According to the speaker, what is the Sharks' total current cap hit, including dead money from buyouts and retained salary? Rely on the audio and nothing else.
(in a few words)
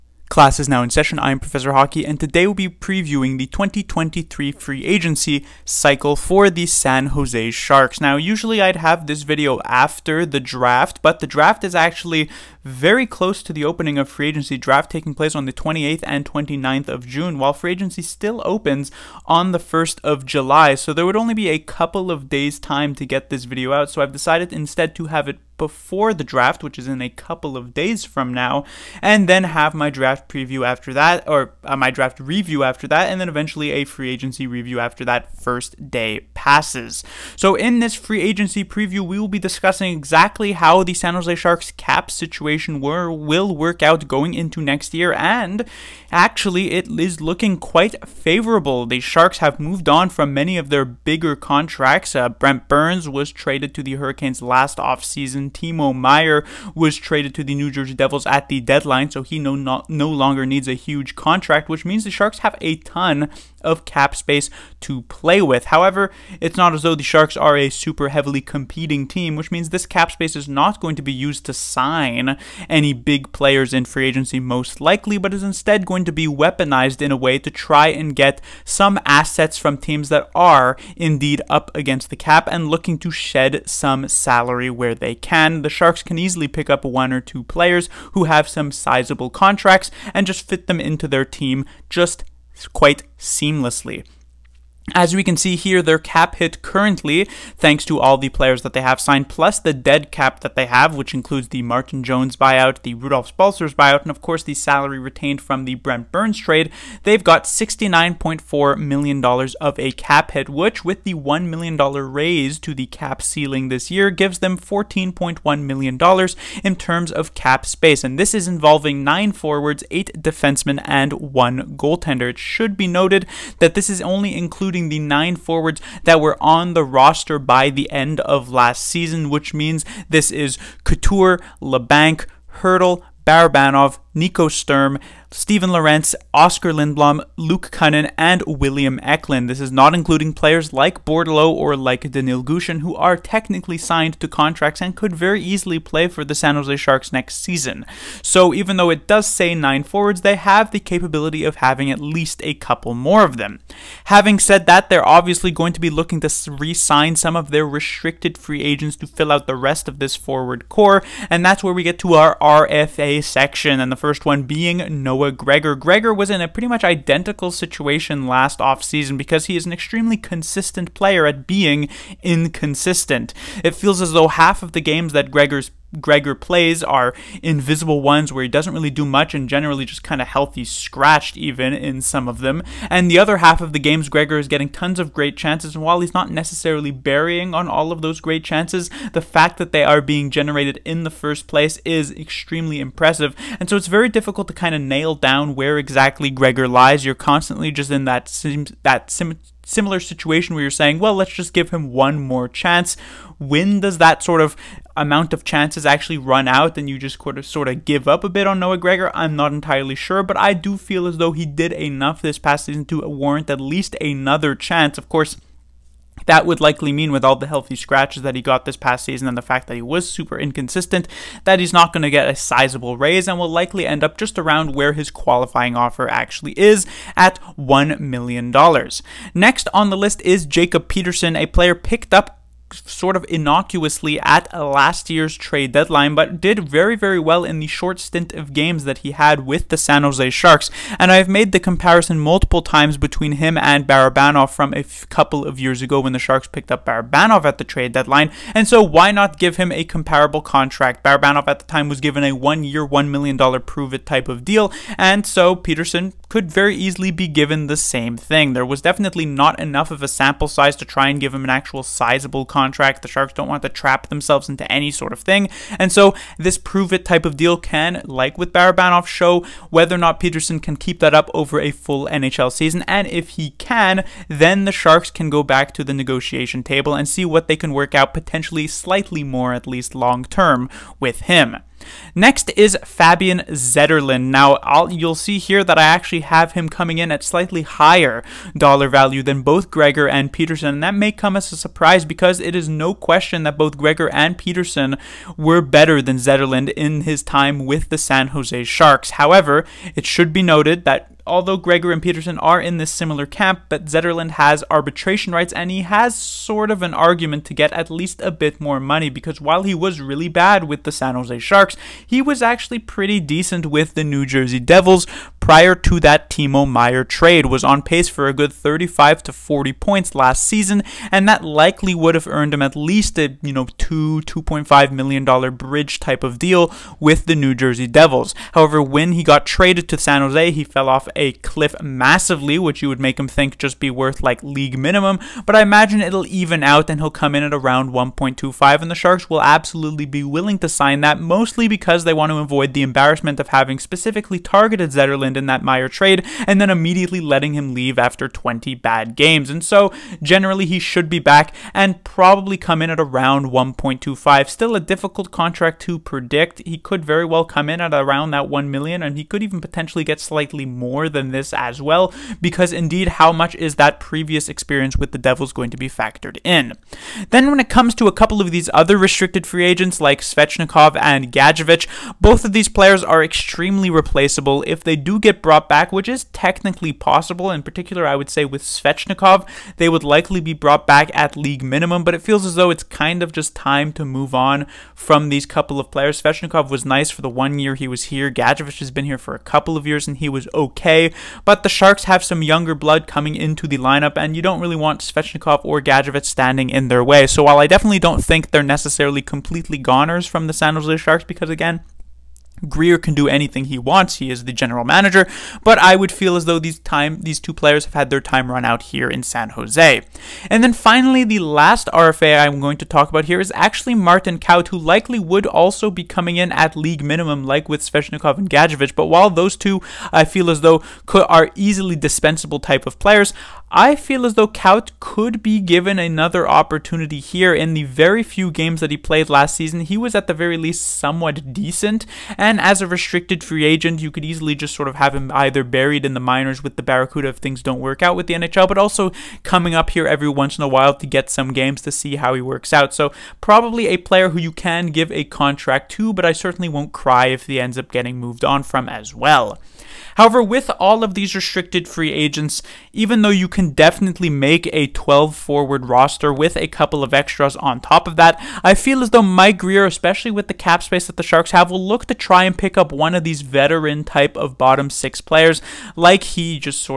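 $69.4 million.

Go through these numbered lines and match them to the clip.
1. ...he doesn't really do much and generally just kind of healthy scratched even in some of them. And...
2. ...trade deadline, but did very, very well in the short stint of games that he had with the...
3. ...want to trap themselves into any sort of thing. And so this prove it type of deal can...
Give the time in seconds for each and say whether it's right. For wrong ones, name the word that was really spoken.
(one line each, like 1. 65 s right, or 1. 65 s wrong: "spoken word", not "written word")
1. 178 s right
2. 235 s right
3. 263 s right.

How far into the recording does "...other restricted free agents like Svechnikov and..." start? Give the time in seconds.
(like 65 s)
368 s.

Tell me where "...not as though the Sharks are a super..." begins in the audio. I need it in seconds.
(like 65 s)
66 s.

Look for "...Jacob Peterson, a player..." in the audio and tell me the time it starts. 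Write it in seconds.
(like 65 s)
230 s.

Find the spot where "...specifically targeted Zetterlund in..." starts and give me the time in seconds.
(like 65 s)
343 s.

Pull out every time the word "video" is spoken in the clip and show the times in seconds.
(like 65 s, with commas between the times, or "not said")
9 s, 23 s.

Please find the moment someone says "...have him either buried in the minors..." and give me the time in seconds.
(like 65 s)
434 s.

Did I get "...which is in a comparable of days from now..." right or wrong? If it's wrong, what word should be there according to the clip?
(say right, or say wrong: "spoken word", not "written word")
wrong: "couple", not "comparable".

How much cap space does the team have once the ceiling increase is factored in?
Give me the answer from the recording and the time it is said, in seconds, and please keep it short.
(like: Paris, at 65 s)
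$14.1 million, at 114 s.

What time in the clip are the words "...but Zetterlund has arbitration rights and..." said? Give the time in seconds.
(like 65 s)
303 s.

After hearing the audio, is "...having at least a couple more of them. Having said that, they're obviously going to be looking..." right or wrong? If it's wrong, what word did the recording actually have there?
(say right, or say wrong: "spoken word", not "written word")
right.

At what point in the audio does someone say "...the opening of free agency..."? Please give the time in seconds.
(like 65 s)
13 s.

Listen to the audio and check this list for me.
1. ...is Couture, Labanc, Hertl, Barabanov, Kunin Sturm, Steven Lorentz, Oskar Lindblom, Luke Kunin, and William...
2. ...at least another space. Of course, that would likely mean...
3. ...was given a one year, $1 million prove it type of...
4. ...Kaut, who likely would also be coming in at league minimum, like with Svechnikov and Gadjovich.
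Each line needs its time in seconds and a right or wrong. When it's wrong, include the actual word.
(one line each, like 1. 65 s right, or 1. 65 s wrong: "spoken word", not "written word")
1. 130 s wrong: "Nico", not "Kunin"
2. 213 s wrong: "chance", not "space"
3. 251 s right
4. 414 s right.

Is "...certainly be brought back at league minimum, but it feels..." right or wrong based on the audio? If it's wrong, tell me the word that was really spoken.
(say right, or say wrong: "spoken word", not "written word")
wrong: "likely", not "certainly".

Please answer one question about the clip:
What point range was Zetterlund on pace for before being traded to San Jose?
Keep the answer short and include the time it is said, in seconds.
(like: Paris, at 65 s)
35 to 40 points, at 318 s.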